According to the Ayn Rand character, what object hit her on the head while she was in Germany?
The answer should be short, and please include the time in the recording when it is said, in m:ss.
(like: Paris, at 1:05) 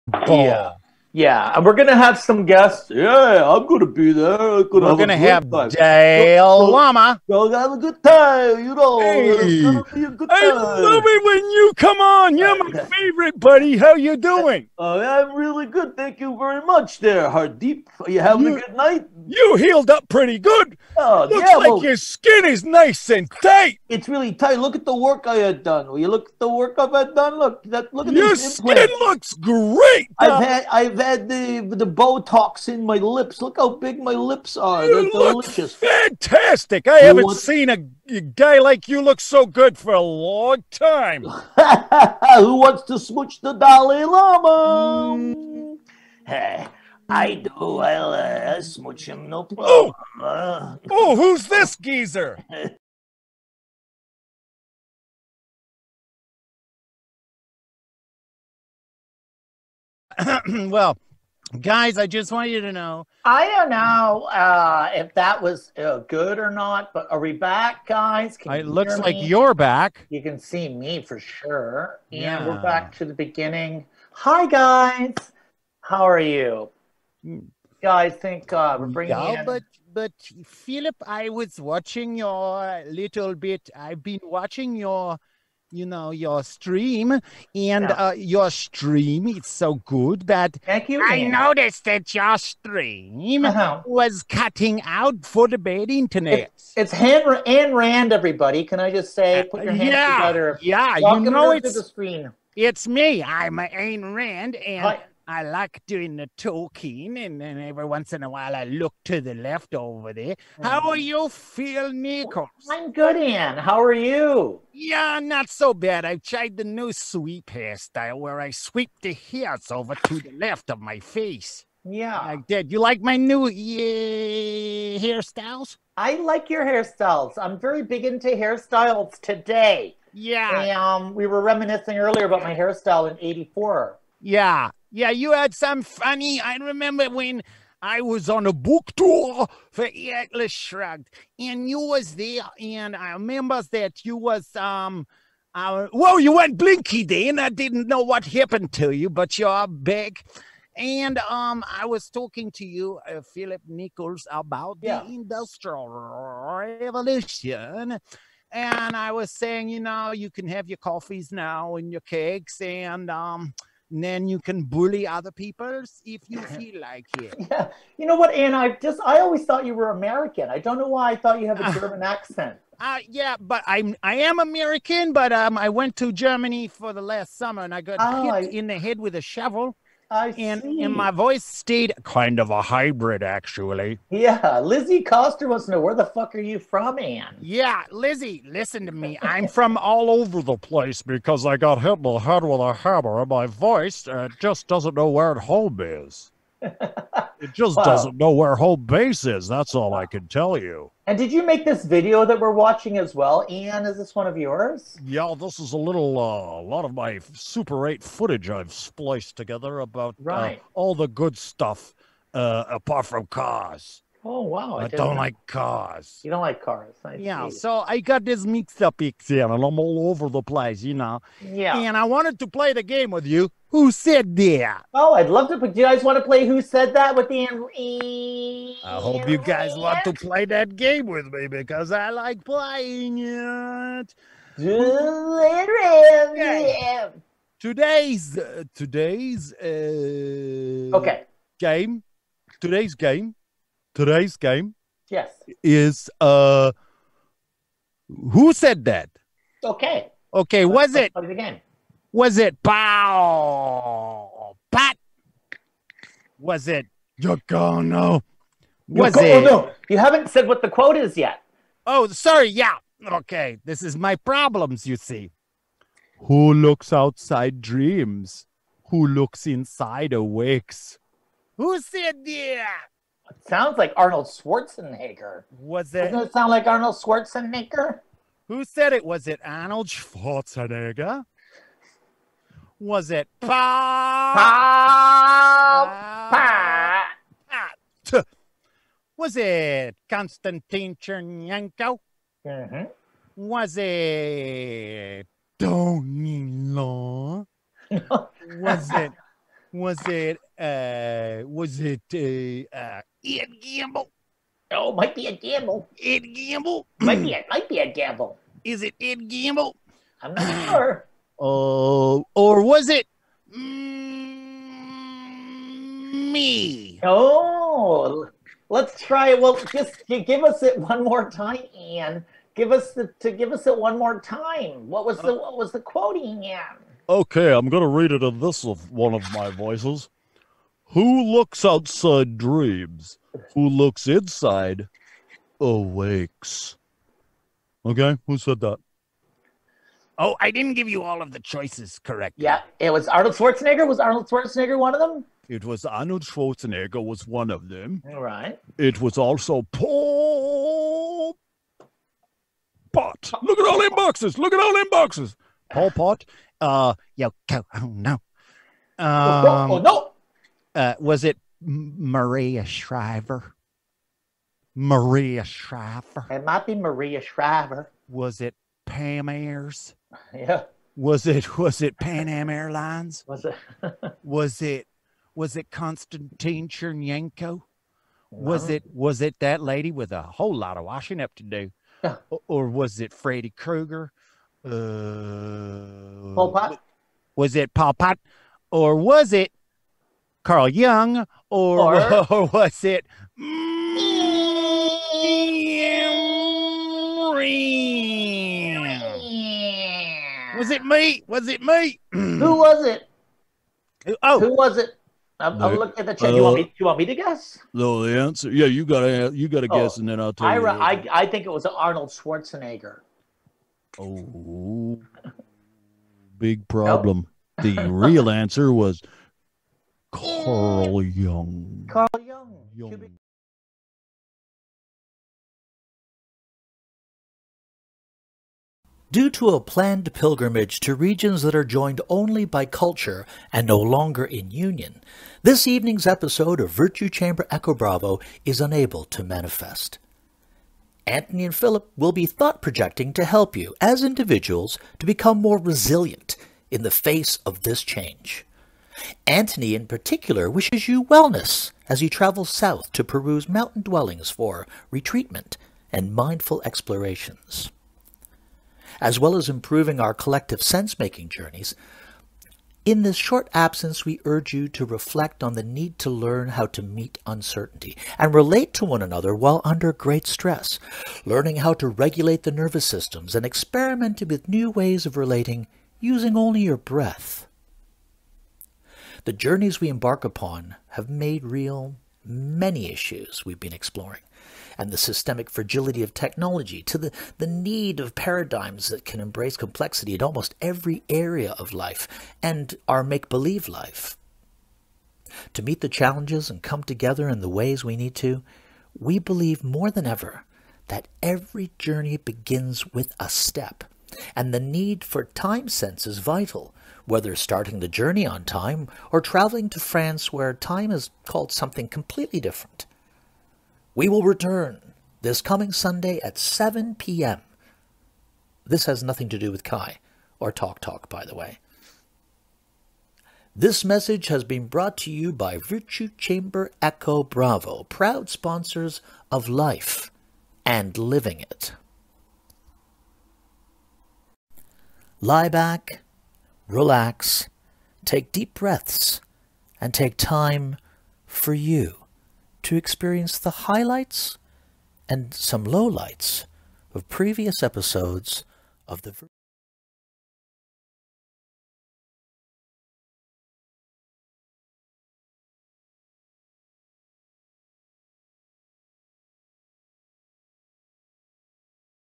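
a shovel, at 2:59.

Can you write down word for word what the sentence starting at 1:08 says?
Can it looks like you're back.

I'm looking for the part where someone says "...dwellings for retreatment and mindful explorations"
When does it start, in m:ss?
7:33.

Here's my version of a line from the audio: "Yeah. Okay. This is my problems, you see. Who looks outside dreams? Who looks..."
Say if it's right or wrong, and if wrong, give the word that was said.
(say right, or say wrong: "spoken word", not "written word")
right.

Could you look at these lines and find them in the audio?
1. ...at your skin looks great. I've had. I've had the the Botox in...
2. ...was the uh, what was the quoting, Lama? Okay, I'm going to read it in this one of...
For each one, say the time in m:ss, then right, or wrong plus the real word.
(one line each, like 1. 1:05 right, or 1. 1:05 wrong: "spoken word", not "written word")
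1. 0:28 right
2. 5:25 wrong: "Ian", not "Lama".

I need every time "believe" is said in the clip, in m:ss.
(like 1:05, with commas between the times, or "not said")
8:13, 8:19.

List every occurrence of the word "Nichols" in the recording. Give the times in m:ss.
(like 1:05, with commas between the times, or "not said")
1:51, 2:33.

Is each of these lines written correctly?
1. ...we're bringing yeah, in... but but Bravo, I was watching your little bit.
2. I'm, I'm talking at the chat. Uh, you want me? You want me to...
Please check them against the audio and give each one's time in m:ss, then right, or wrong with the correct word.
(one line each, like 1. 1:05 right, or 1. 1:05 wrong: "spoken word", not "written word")
1. 1:18 wrong: "Philip", not "Bravo"
2. 6:45 wrong: "looking", not "talking".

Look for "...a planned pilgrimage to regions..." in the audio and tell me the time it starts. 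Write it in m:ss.
7:09.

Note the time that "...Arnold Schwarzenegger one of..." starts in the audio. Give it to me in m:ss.
5:43.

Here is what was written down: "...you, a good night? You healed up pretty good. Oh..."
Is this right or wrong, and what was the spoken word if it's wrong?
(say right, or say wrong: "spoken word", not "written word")
right.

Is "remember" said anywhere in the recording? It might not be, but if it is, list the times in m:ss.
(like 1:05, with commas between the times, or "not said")
2:16, 2:23.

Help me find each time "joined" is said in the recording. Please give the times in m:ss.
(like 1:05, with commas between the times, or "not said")
7:11.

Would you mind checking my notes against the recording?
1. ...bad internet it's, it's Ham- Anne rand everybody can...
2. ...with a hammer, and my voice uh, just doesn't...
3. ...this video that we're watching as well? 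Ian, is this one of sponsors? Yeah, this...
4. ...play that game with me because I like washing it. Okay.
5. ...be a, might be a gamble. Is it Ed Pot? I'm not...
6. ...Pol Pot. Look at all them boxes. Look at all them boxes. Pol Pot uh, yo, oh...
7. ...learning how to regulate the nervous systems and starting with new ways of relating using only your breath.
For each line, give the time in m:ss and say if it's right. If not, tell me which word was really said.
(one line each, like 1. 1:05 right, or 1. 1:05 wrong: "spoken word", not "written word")
1. 1:35 right
2. 3:12 right
3. 3:21 wrong: "yours", not "sponsors"
4. 3:50 wrong: "playing", not "washing"
5. 5:07 wrong: "Gamble", not "Pot"
6. 5:49 right
7. 7:51 wrong: "experimenting", not "starting".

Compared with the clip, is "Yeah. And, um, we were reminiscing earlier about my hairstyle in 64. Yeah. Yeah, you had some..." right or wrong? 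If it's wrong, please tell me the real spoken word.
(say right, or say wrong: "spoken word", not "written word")
wrong: "84", not "64".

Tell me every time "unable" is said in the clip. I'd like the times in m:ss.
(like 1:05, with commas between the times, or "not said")
7:18.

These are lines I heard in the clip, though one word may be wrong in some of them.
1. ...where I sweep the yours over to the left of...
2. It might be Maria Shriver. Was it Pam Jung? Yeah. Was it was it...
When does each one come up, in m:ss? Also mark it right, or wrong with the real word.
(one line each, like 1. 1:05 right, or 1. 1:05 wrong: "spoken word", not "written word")
1. 1:58 wrong: "hairs", not "yours"
2. 6:06 wrong: "Ayres", not "Jung".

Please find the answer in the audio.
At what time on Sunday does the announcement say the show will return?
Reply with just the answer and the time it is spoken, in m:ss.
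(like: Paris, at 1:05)
7 p.m., at 8:36.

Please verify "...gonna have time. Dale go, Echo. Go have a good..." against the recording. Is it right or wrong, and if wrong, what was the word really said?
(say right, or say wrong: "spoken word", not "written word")
wrong: "Lama", not "Echo".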